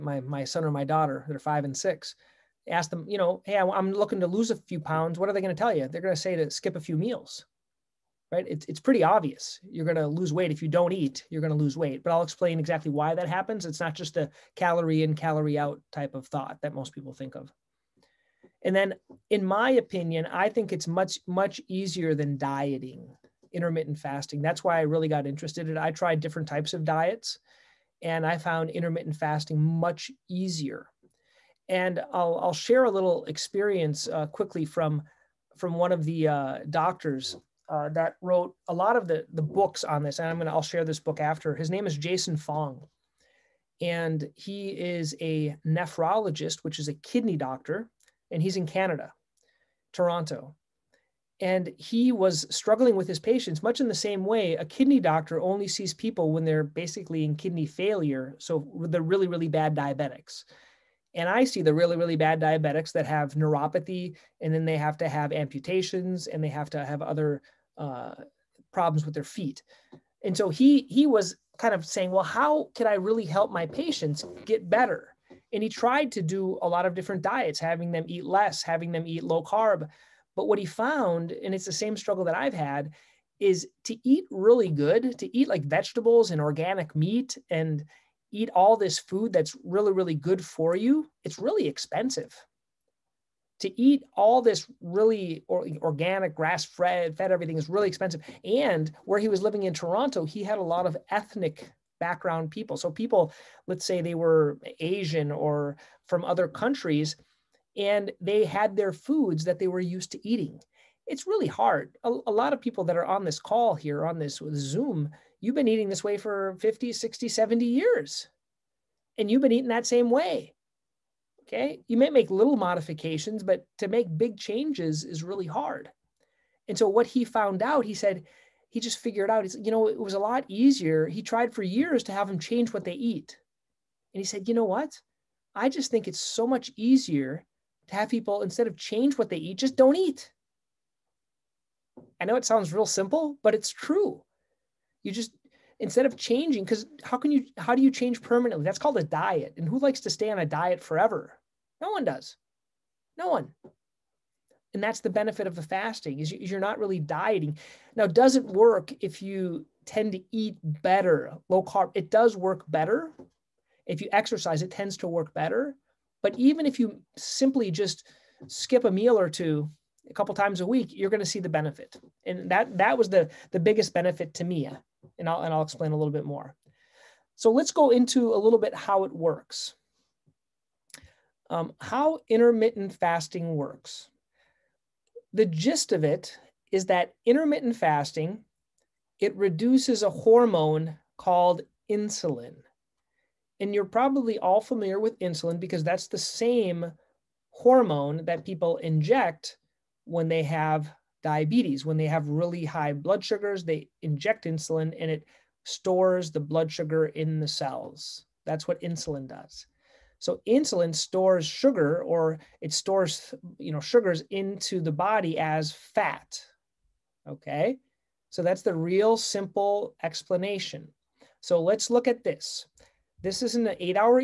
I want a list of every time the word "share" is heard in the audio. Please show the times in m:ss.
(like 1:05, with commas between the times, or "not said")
0:32, 0:40.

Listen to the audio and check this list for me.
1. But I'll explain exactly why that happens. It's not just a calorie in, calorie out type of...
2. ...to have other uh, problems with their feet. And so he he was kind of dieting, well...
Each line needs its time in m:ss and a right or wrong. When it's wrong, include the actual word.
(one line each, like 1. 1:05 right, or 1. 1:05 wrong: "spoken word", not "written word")
1. 0:12 right
2. 1:06 wrong: "saying", not "dieting".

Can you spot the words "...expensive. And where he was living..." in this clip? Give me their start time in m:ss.
1:37.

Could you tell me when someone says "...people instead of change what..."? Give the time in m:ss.
2:18.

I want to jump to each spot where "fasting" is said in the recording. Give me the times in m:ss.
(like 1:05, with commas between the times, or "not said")
0:23, 0:29, 2:35, 3:02, 3:07.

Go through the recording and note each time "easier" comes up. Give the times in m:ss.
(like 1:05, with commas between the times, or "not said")
0:21, 0:30, 2:10, 2:16.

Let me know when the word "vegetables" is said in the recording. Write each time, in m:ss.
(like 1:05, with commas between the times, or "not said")
1:25.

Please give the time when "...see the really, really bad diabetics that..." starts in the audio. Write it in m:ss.
1:01.